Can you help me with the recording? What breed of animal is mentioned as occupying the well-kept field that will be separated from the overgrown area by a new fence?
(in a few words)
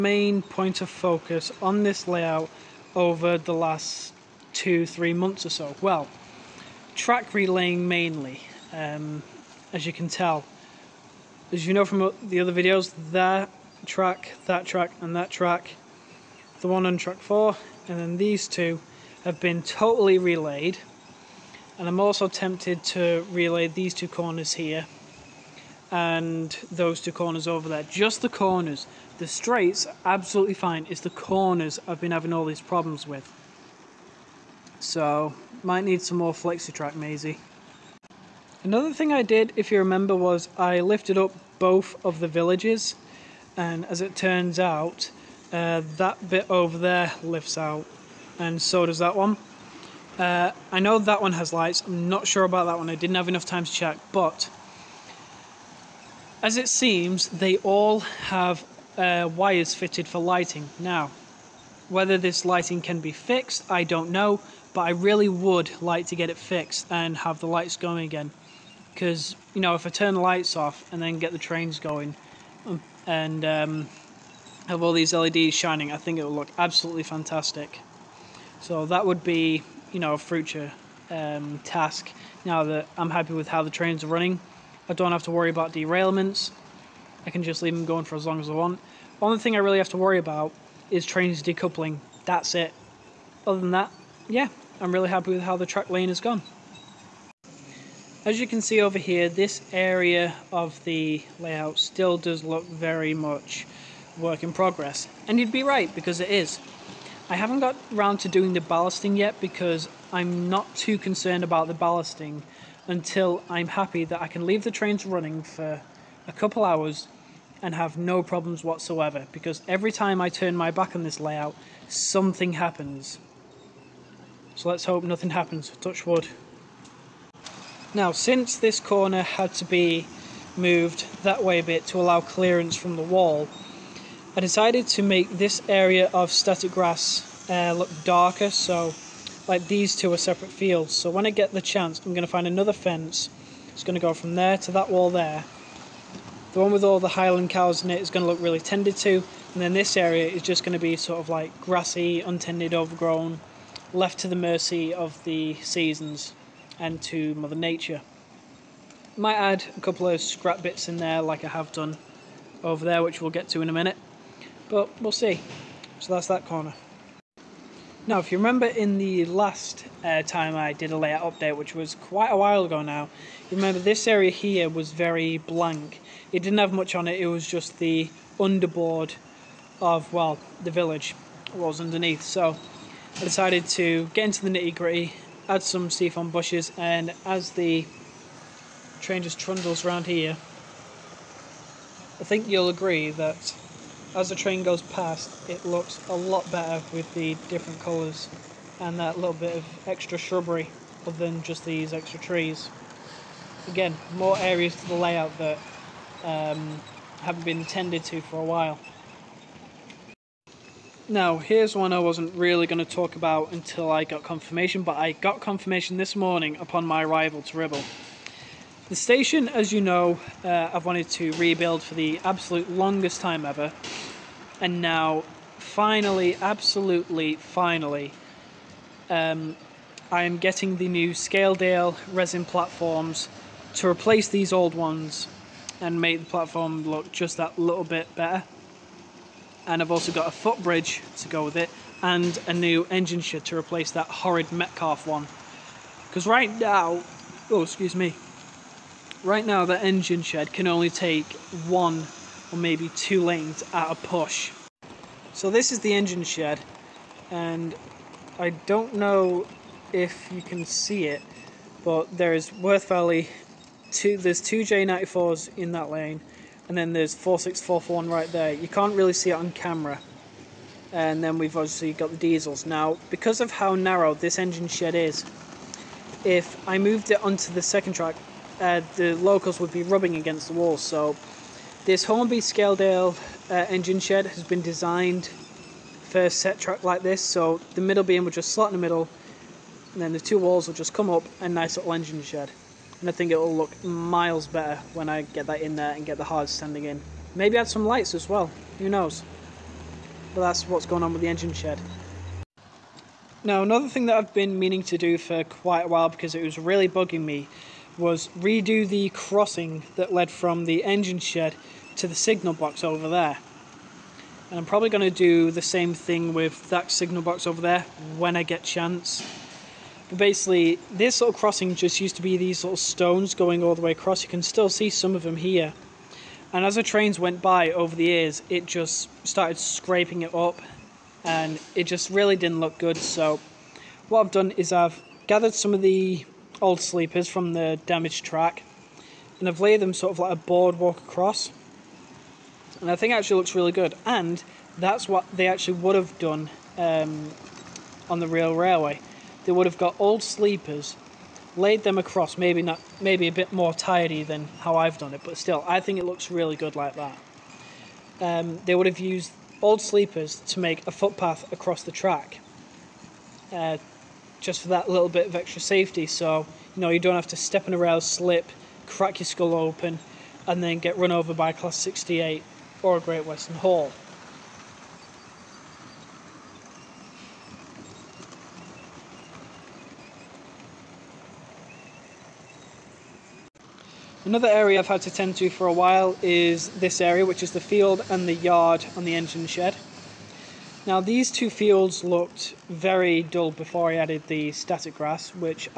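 Highland cows.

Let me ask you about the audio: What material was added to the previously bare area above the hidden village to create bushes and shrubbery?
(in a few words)
Seafoam.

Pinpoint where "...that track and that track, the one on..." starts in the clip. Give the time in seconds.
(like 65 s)
14 s.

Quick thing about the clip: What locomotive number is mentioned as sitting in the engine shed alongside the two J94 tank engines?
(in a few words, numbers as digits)
4641.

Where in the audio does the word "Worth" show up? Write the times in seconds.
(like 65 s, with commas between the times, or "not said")
262 s.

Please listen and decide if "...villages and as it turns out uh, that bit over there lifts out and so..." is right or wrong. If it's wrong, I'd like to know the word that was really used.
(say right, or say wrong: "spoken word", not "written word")
right.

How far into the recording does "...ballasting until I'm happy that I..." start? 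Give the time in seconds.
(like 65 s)
111 s.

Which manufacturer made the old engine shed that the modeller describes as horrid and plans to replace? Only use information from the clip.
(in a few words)
Metcalfe.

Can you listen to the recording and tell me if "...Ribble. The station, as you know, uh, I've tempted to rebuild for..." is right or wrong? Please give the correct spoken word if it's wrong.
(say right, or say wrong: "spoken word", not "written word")
wrong: "wanted", not "tempted".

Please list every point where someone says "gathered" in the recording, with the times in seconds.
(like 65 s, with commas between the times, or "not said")
335 s.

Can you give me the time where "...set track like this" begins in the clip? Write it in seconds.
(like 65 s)
286 s.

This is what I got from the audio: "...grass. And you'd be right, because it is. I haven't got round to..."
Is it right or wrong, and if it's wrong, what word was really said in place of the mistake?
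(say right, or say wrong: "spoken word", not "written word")
wrong: "progress", not "grass".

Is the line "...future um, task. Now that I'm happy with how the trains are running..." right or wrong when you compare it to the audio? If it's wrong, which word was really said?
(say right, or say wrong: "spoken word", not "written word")
right.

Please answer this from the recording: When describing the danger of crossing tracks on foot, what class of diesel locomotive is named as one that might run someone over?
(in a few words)
Class 68.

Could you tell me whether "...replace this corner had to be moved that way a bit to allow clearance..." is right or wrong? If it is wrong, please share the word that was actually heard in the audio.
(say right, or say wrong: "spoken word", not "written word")
wrong: "since", not "replace".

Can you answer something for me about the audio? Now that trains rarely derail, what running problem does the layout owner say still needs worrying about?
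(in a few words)
Trains decoupling.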